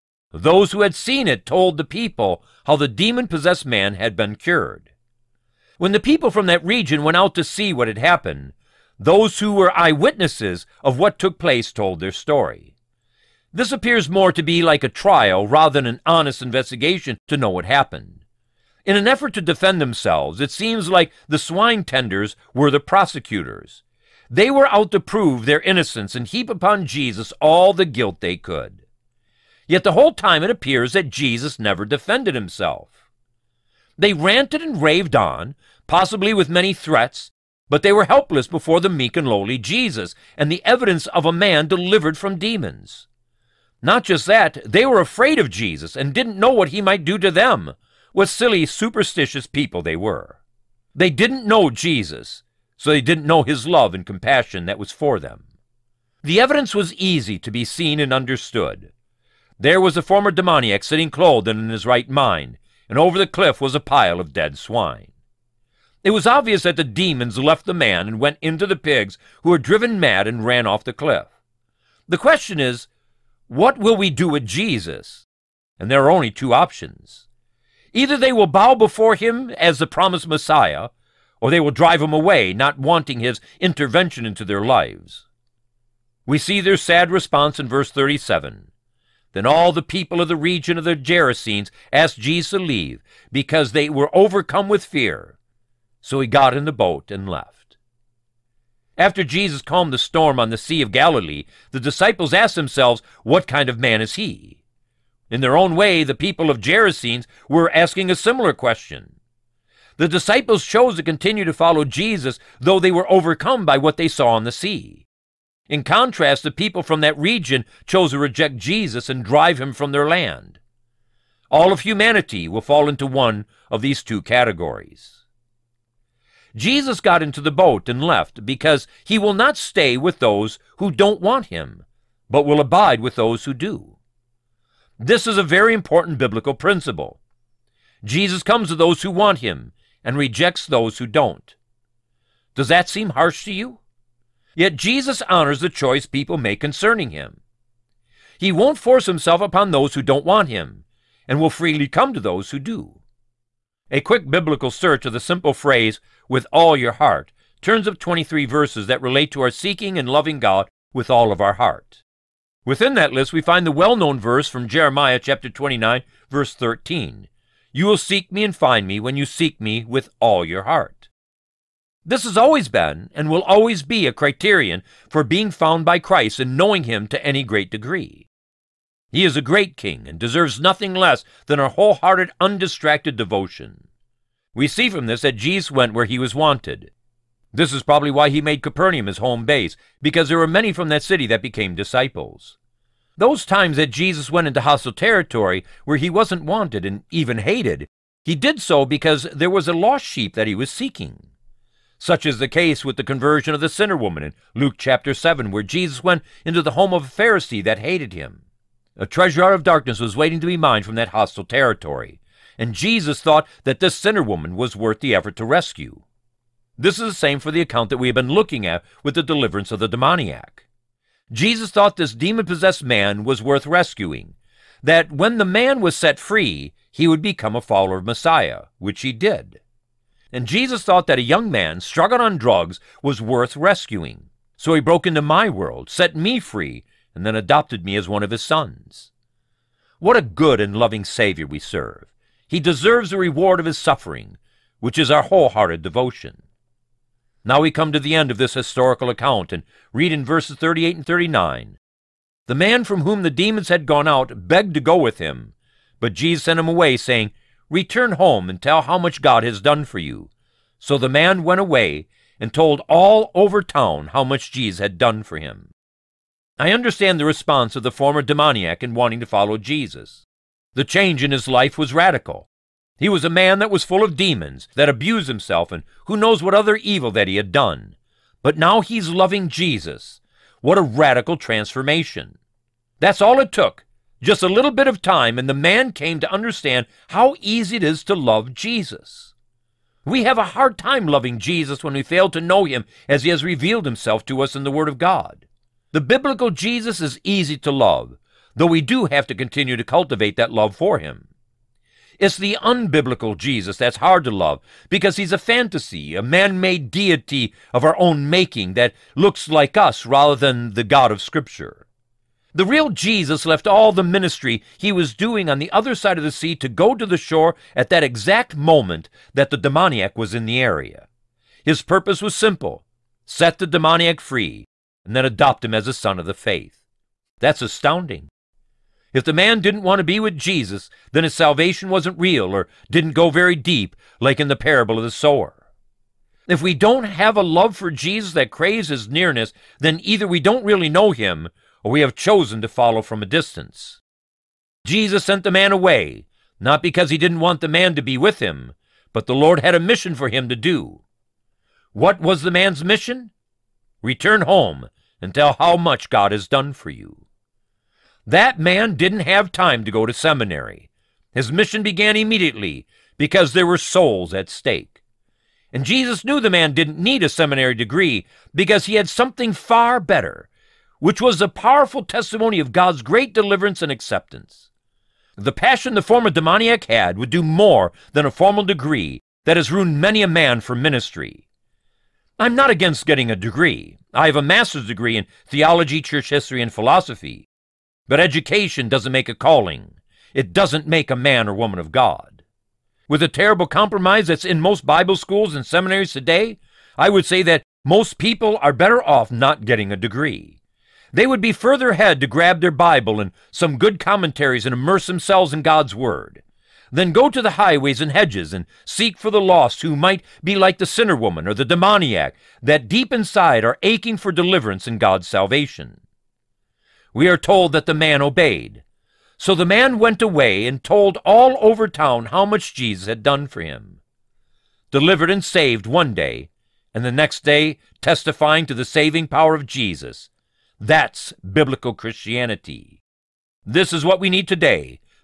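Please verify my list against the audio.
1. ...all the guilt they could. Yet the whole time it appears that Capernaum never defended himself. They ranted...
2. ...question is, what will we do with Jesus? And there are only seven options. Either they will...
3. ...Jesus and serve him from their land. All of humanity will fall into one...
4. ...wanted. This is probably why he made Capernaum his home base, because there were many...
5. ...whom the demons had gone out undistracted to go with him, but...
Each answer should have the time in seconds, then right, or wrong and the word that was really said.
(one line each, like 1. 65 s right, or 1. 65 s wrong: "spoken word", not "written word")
1. 27 s wrong: "Jesus", not "Capernaum"
2. 72 s wrong: "two", not "seven"
3. 118 s wrong: "drive", not "serve"
4. 186 s right
5. 253 s wrong: "begged", not "undistracted".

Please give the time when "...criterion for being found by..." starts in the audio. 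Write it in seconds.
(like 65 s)
174 s.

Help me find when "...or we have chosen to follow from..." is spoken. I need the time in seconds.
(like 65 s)
341 s.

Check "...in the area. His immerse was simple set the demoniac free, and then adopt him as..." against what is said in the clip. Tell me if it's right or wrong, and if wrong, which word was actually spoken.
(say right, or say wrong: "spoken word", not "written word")
wrong: "purpose", not "immerse".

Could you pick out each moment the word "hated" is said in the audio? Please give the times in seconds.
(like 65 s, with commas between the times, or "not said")
197 s, 207 s.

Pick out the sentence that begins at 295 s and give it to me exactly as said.
The biblical Jesus is easy to love, though we do have to continue to cultivate that love for him.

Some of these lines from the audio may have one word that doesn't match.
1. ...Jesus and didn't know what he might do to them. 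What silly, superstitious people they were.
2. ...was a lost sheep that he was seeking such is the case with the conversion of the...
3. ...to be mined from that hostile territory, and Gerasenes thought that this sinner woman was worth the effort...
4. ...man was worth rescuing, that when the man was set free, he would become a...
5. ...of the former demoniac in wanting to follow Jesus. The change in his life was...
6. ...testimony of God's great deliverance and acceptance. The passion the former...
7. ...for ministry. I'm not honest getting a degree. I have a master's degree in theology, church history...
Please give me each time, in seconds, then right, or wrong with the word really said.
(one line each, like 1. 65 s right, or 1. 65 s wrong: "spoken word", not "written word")
1. 45 s right
2. 199 s right
3. 210 s wrong: "Jesus", not "Gerasenes"
4. 222 s right
5. 267 s right
6. 372 s right
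7. 380 s wrong: "against", not "honest".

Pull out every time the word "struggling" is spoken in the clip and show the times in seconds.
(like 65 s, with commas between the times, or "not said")
231 s.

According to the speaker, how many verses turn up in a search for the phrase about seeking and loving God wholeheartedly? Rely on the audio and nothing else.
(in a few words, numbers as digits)
23.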